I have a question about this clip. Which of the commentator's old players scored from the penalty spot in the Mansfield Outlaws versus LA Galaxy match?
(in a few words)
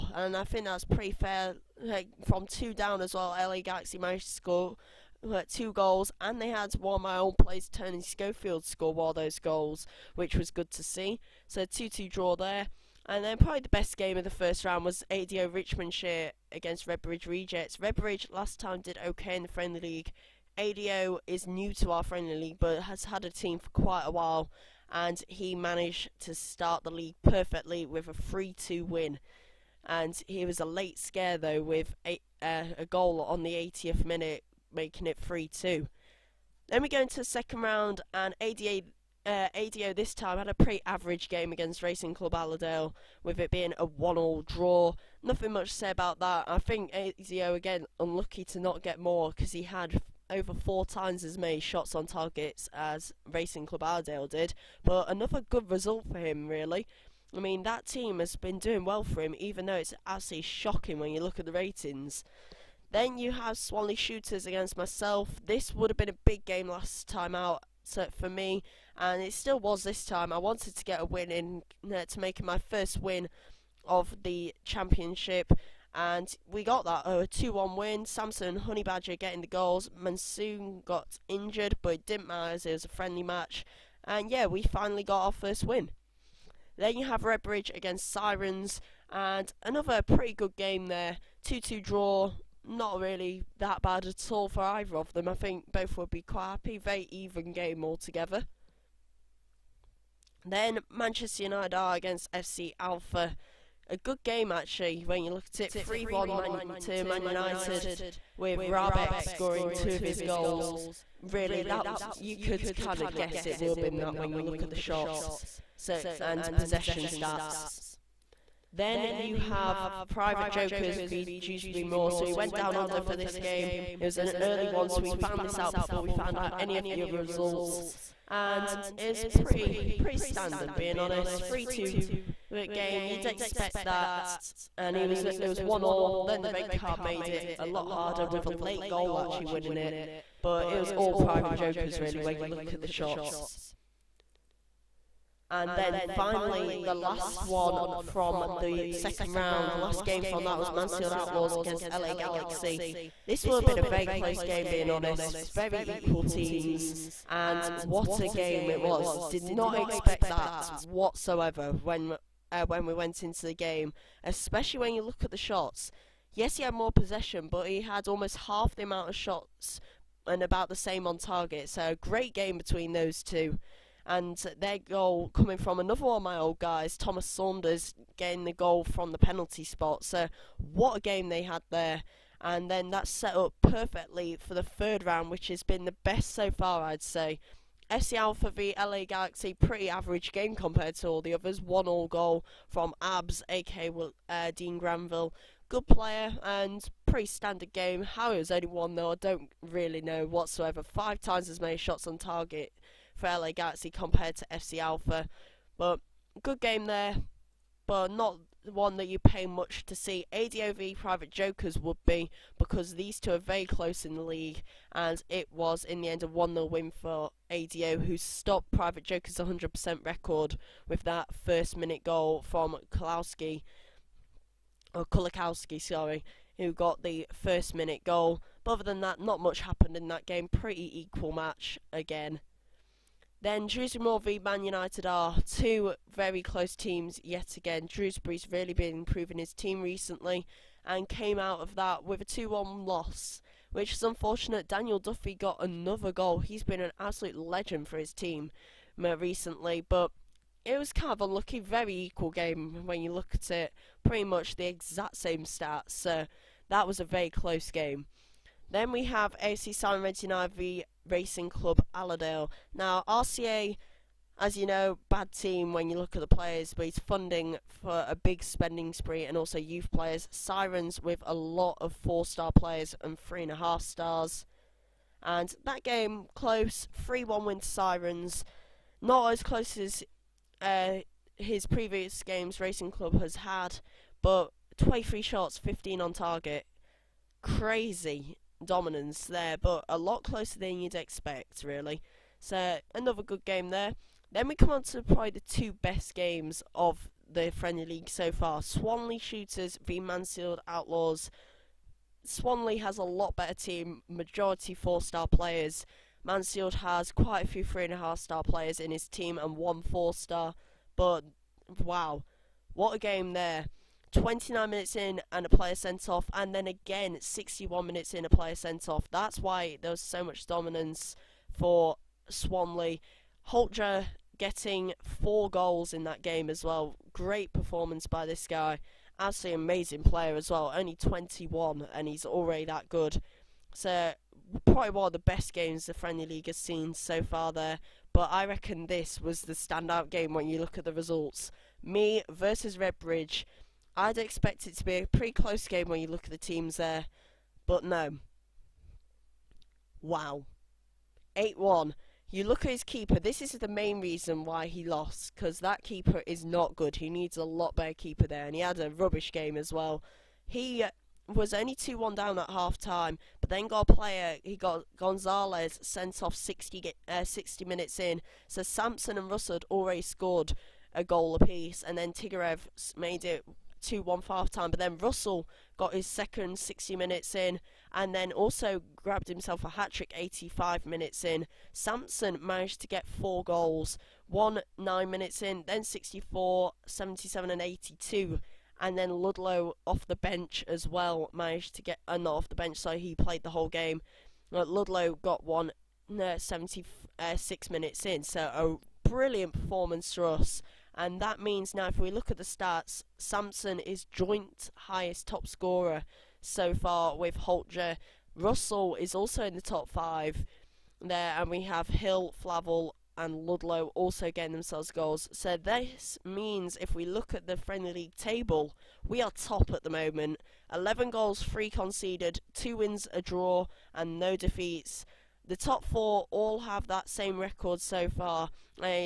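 Thomas Saunders.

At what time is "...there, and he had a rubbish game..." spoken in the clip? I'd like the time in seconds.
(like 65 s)
358 s.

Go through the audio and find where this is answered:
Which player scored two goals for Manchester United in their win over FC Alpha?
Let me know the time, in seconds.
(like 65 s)
108 s.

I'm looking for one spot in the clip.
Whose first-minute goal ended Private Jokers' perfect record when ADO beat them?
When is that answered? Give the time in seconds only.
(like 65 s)
225 s.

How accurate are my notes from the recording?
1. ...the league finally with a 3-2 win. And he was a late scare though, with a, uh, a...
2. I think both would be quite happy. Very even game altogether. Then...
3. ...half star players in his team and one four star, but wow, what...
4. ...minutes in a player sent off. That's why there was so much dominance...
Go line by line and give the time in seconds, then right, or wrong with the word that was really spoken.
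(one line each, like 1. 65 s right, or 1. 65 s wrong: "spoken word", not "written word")
1. 26 s wrong: "perfectly", not "finally"
2. 95 s right
3. 307 s right
4. 317 s right.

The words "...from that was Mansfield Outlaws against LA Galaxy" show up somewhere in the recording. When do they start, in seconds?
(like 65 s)
150 s.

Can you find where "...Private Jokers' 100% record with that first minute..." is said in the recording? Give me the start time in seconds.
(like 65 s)
218 s.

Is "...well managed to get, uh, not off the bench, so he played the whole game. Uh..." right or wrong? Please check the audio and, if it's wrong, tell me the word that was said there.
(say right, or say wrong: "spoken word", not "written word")
right.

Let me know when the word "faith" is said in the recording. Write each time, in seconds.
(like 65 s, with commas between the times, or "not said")
not said.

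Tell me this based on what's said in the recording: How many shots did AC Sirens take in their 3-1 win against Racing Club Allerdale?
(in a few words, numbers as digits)
23.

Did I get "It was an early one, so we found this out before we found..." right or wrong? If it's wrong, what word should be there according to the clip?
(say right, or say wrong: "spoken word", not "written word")
right.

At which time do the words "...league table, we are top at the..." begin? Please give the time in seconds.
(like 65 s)
417 s.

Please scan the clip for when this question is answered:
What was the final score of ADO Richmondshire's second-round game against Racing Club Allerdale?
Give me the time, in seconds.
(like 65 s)
43 s.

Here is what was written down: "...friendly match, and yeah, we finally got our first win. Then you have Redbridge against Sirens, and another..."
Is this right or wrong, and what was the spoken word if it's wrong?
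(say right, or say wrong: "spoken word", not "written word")
right.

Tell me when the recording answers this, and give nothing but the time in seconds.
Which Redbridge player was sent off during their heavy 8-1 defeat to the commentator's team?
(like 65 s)
364 s.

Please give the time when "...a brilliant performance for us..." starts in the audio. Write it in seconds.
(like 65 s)
399 s.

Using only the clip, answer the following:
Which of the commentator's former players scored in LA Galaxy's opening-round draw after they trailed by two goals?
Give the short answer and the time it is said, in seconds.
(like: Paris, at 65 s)
Tony Schofield, at 7 s.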